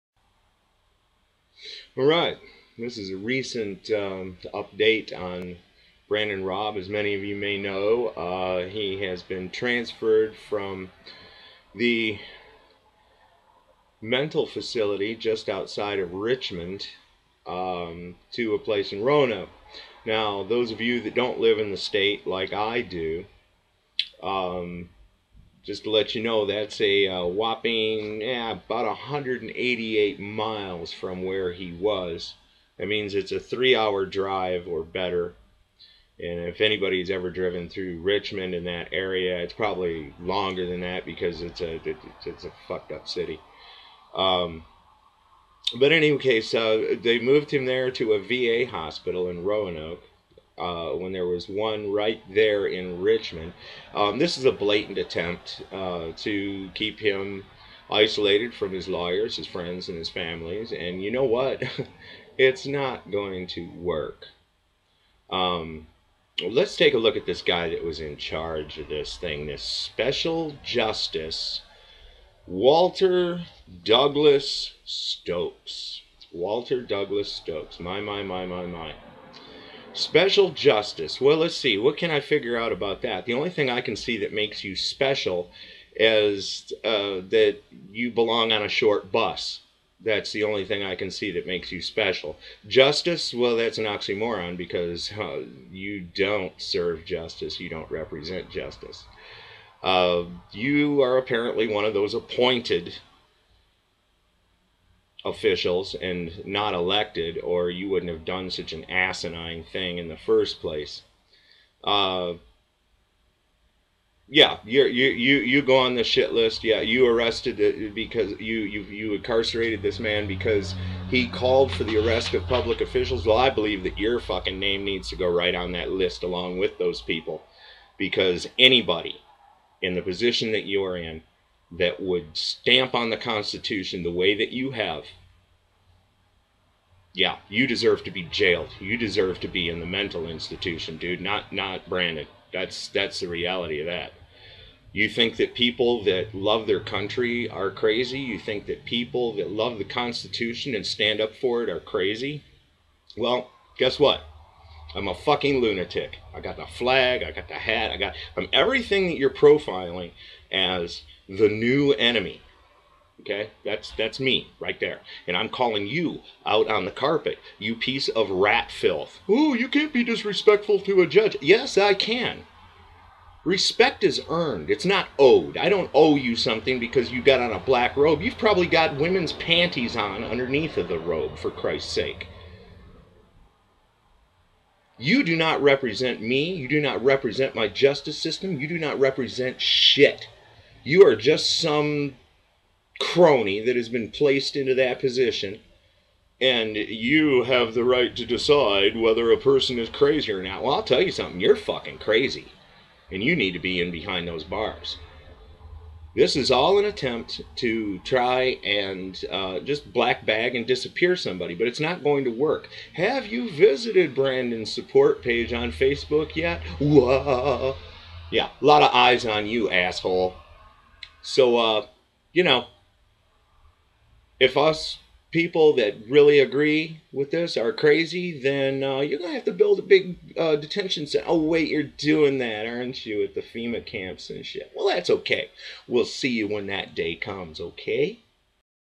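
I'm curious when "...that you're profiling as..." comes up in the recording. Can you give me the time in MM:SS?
02:39.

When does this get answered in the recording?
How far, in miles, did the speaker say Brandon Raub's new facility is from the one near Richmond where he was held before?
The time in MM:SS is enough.
00:28.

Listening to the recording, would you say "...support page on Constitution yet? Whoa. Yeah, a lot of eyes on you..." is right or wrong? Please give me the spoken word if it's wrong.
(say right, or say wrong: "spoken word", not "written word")
wrong: "Facebook", not "Constitution".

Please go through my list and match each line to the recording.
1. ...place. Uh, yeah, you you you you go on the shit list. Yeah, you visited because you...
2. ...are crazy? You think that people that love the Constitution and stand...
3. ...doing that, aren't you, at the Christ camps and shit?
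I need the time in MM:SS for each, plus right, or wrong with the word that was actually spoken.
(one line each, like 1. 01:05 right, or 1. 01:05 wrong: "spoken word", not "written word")
1. 01:50 wrong: "arrested", not "visited"
2. 02:27 right
3. 03:51 wrong: "FEMA", not "Christ".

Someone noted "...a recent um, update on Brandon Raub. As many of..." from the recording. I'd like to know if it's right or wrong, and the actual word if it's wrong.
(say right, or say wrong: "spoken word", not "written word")
right.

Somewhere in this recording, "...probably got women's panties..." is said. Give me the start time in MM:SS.
02:58.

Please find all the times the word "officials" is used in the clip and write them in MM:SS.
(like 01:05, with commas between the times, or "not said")
01:45, 02:02.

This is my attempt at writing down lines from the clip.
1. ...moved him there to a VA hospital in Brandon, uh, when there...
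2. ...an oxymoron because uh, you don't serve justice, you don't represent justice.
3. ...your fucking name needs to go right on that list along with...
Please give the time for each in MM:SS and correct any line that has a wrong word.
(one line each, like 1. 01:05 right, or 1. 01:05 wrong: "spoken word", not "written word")
1. 00:47 wrong: "Roanoke", not "Brandon"
2. 01:33 right
3. 02:03 right.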